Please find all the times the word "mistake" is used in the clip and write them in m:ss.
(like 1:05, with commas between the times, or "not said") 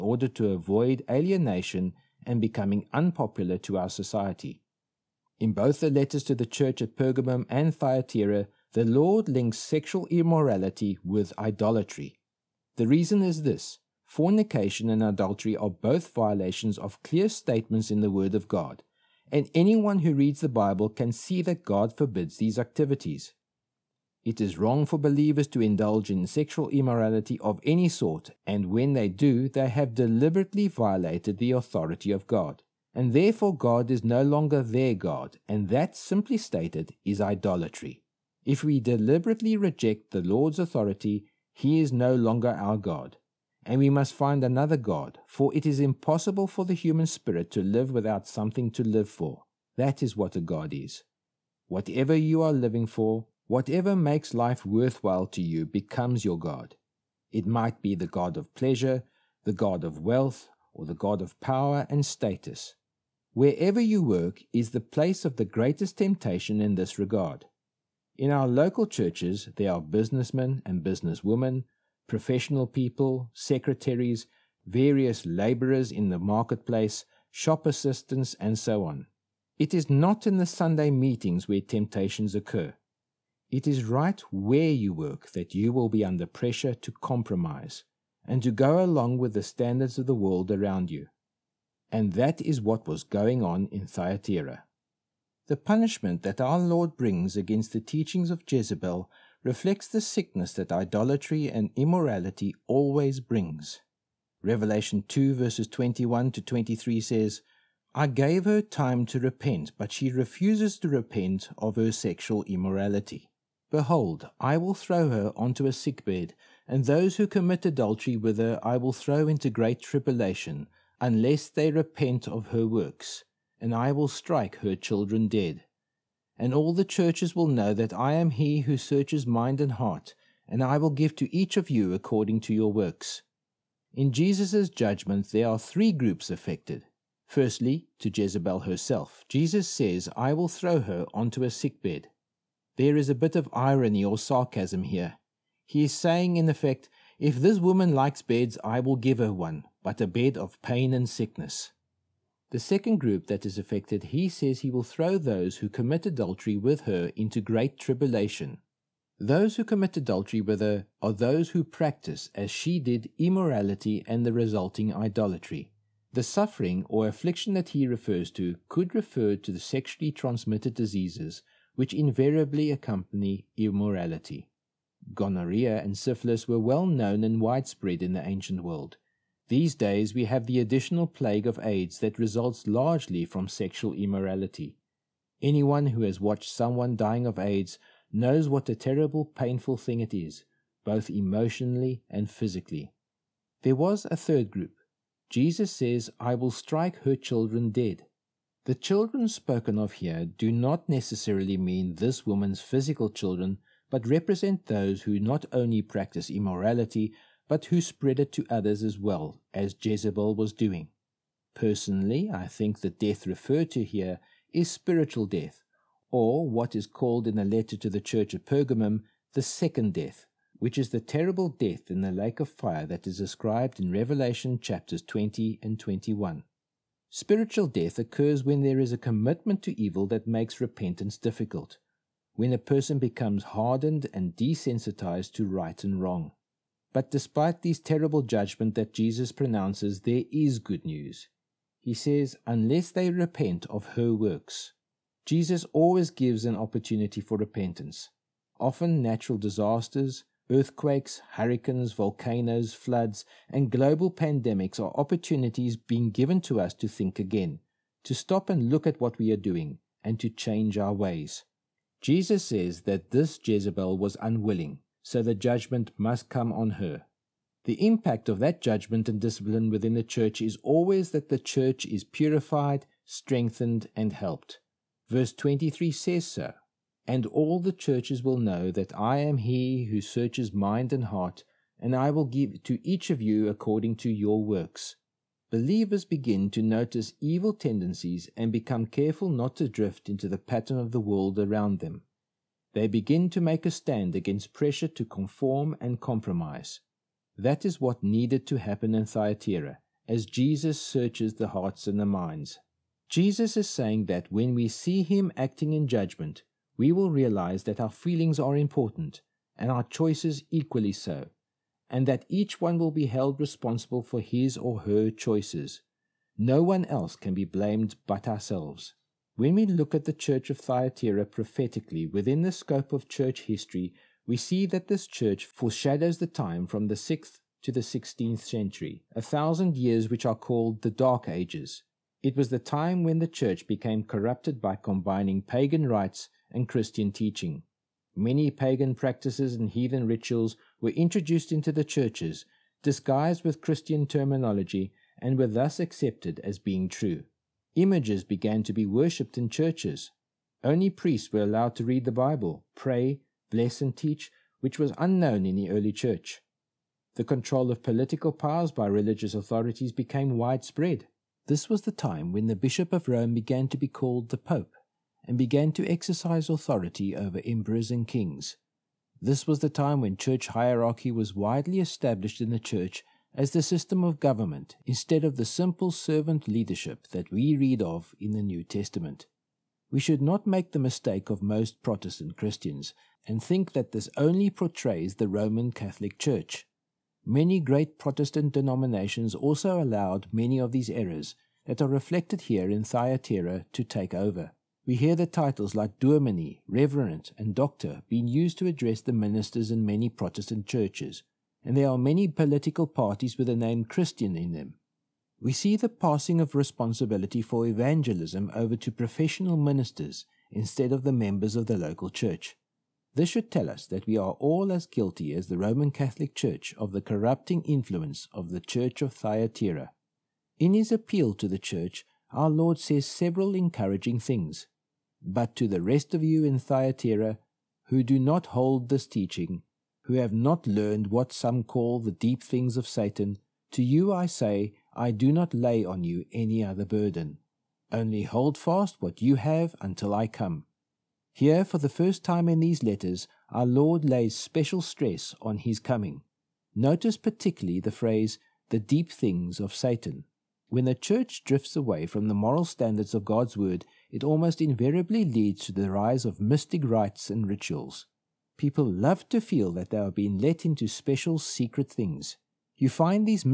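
6:20.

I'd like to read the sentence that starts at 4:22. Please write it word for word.
Jesus says that this Jezebel was unwilling, so the judgment must come on her.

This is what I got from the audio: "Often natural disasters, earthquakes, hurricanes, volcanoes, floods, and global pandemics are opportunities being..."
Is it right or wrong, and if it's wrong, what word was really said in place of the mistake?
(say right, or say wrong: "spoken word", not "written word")
right.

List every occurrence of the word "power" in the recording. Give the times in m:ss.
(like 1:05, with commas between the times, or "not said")
1:01, 5:58.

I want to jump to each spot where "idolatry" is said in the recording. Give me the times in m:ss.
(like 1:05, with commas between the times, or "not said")
0:11, 0:37, 1:40, 2:44.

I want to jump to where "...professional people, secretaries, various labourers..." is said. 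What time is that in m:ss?
1:12.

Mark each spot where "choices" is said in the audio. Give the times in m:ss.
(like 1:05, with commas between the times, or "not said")
5:09, 5:15.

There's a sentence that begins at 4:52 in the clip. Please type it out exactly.
They begin to make a stand against pressure to conform and compromise.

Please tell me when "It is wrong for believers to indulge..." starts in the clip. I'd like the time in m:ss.
0:24.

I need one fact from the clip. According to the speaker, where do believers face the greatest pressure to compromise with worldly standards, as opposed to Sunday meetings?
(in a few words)
Where you work.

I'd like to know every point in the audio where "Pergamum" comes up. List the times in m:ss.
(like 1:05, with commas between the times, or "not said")
0:06, 3:38.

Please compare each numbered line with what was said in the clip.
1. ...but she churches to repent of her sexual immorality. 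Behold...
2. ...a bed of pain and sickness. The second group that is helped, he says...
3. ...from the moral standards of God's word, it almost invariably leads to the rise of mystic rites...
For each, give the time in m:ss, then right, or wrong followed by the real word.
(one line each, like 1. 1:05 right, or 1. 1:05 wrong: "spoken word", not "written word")
1. 1:49 wrong: "refuses", not "churches"
2. 2:30 wrong: "affected", not "helped"
3. 7:32 right.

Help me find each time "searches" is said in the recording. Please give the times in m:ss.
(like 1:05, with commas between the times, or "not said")
2:08, 4:40, 5:00.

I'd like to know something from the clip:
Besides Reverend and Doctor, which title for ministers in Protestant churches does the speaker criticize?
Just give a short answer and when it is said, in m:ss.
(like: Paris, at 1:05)
Dominee, at 6:36.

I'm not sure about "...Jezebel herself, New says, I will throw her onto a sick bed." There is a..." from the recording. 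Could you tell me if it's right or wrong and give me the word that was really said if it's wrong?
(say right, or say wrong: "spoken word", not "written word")
wrong: "Jesus", not "New".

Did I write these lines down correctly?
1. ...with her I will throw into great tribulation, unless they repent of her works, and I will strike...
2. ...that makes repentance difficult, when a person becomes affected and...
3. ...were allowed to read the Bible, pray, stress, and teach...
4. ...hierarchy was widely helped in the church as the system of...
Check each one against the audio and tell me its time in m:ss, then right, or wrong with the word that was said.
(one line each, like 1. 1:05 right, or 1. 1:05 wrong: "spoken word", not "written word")
1. 1:58 right
2. 3:50 wrong: "hardened", not "affected"
3. 5:51 wrong: "bless", not "stress"
4. 6:10 wrong: "established", not "helped".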